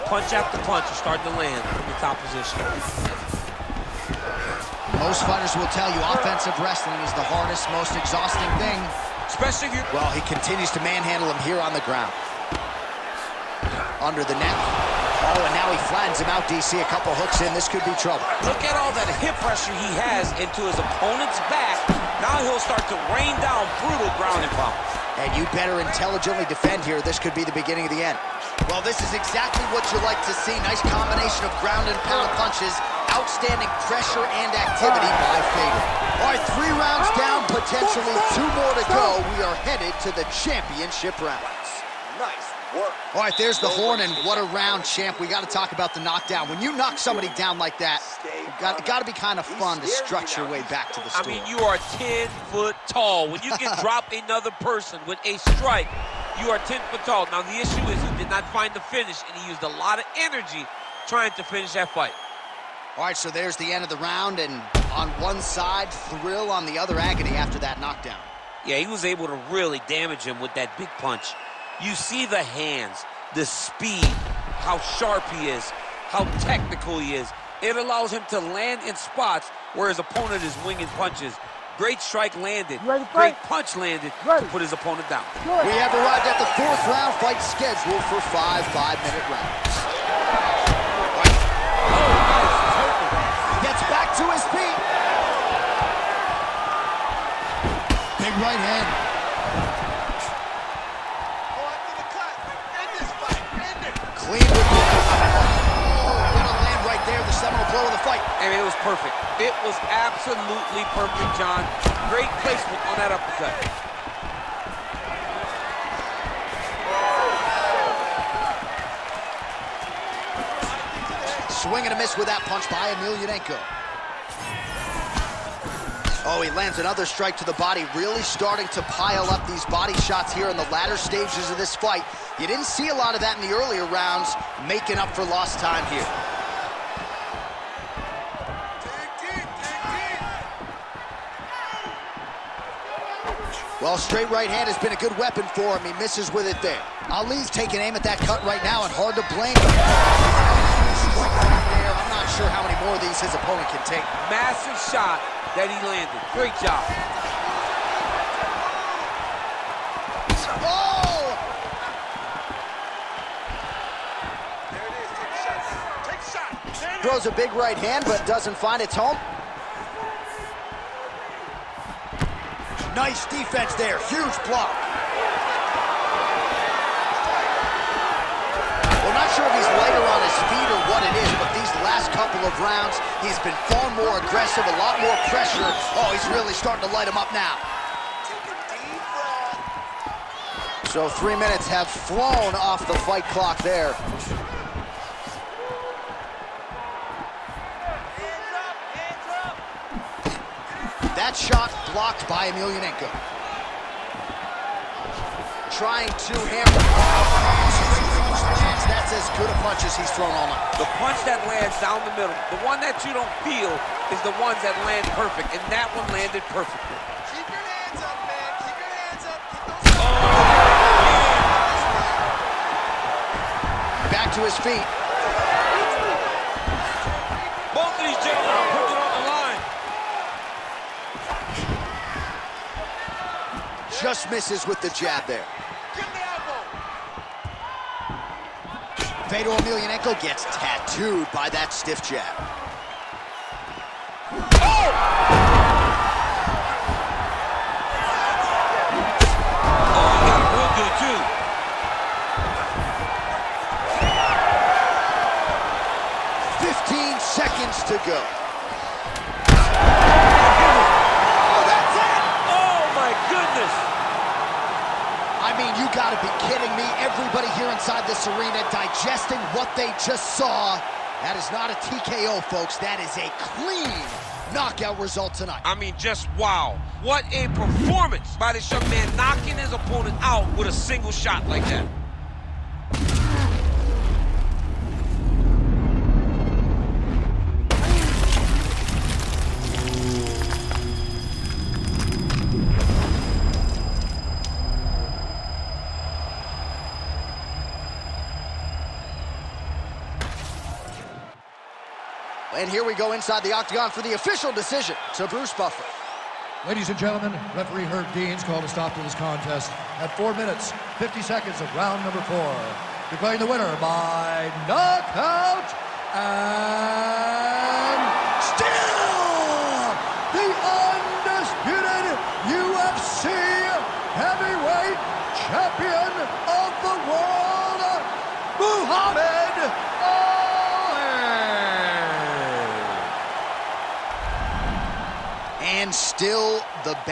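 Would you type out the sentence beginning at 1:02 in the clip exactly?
All right, so there's the end of the round, and on one side, thrill, on the other, agony after that knockdown.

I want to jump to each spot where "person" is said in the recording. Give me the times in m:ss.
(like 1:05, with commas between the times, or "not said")
0:54.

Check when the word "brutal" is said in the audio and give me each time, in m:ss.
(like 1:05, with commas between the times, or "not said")
0:23.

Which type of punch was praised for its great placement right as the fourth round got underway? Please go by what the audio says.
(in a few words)
Uppercut.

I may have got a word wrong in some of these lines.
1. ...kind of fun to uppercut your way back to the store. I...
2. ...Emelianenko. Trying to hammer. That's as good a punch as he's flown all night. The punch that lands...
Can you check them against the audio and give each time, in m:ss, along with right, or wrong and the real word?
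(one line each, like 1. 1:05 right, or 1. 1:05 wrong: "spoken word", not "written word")
1. 0:49 wrong: "strut", not "uppercut"
2. 3:22 wrong: "thrown", not "flown".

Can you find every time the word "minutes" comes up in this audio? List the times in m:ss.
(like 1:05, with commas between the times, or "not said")
1:28, 3:11, 5:10.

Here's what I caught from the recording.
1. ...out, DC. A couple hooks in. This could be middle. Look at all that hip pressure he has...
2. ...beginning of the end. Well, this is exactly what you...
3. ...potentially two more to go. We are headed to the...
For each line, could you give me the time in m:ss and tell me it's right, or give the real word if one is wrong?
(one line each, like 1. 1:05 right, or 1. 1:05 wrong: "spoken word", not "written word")
1. 0:16 wrong: "trouble", not "middle"
2. 0:27 right
3. 0:37 right.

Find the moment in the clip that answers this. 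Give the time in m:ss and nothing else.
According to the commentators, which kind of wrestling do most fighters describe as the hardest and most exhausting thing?
0:06.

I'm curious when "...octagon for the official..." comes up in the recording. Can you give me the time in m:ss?
5:03.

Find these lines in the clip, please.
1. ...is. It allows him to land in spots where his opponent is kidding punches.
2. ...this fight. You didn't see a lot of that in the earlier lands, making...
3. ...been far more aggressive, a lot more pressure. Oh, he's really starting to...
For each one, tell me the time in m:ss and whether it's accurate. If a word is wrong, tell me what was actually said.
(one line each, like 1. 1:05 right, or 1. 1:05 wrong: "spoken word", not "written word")
1. 1:17 wrong: "winging", not "kidding"
2. 2:11 wrong: "rounds", not "lands"
3. 3:03 right.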